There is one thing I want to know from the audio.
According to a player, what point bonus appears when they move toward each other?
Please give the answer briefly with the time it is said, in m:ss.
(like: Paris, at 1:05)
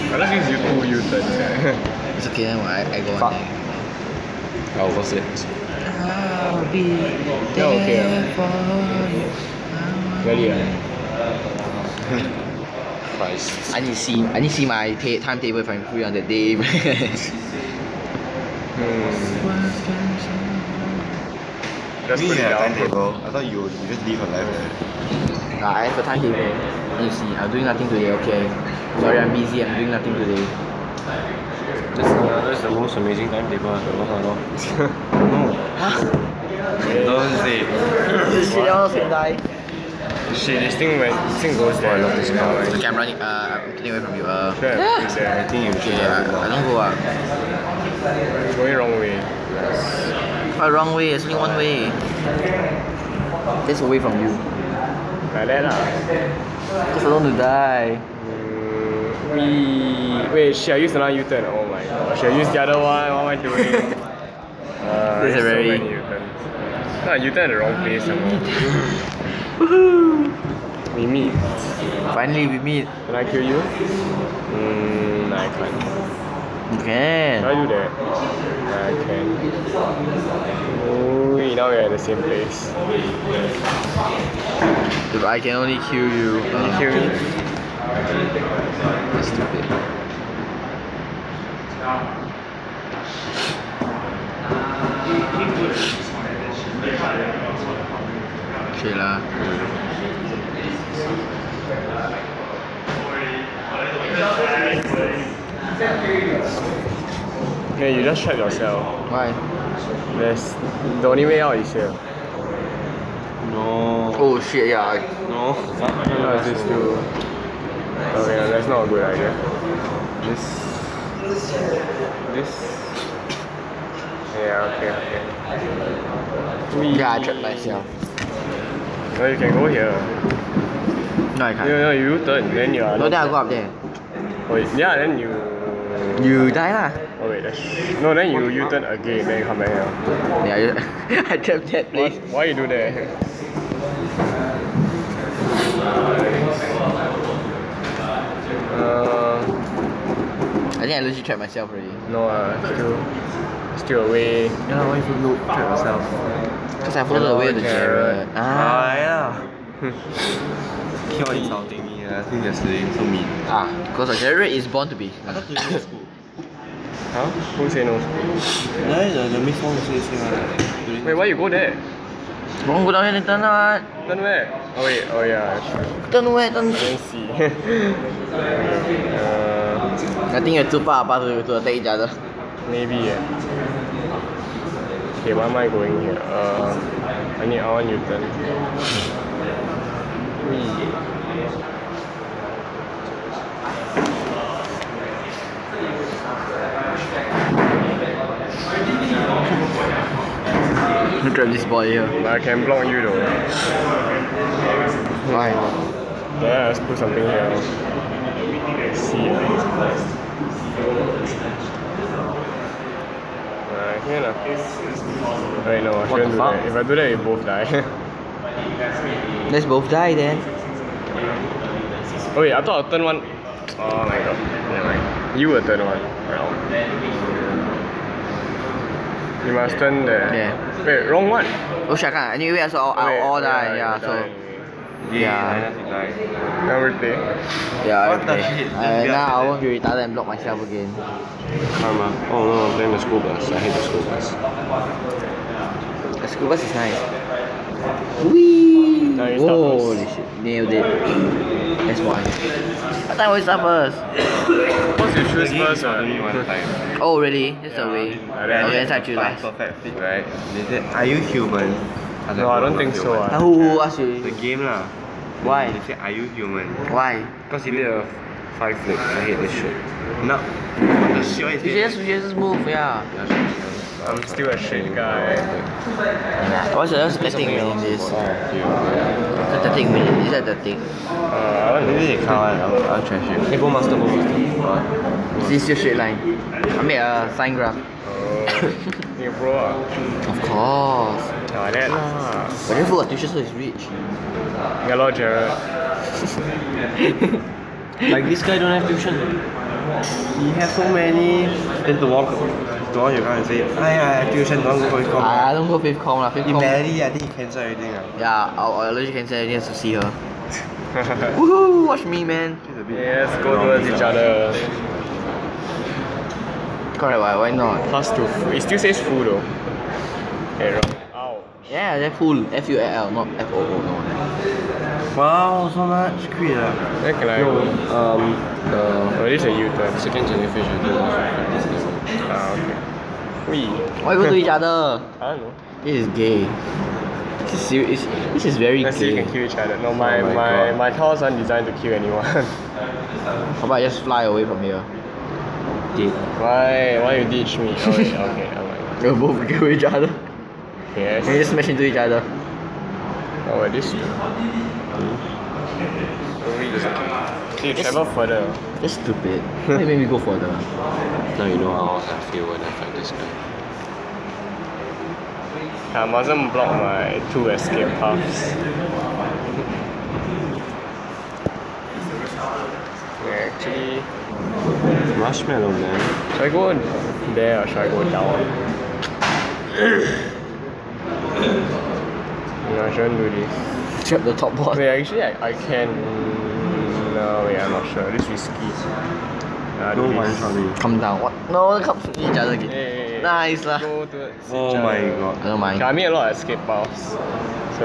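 Plus two, at 5:17.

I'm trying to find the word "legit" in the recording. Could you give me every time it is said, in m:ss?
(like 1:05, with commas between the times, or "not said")
2:30, 5:08.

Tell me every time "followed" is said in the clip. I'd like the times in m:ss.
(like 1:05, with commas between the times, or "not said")
2:37.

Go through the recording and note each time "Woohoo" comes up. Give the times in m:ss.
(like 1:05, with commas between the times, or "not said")
1:09, 5:11.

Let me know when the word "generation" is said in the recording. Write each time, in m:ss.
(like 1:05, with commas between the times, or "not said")
5:30.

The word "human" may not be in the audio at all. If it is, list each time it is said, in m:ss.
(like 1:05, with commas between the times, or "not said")
4:21, 4:26.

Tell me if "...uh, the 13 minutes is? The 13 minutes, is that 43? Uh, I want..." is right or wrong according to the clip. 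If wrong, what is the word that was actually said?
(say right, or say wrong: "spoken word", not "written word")
wrong: "13", not "43".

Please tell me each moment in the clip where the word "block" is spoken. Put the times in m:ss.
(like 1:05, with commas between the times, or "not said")
3:22, 4:00, 6:06.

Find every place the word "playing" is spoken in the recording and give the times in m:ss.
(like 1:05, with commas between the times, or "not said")
4:02.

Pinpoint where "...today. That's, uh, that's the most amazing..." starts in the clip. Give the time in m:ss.
0:30.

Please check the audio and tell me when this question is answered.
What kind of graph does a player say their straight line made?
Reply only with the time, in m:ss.
4:47.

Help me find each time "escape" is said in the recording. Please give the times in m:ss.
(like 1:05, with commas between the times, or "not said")
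6:07, 6:36.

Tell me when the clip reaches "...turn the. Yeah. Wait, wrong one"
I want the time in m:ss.
3:49.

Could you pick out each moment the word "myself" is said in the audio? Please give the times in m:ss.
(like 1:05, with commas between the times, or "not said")
2:07, 2:31, 4:00.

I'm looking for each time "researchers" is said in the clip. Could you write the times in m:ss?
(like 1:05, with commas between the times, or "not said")
not said.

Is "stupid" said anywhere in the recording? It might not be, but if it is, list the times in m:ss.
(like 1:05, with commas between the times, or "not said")
1:32, 5:58.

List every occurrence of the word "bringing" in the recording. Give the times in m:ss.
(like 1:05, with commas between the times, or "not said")
not said.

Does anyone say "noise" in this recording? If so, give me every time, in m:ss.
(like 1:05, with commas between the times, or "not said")
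not said.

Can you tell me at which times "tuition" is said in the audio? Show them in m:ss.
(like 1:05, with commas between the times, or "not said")
4:53, 4:58, 5:04.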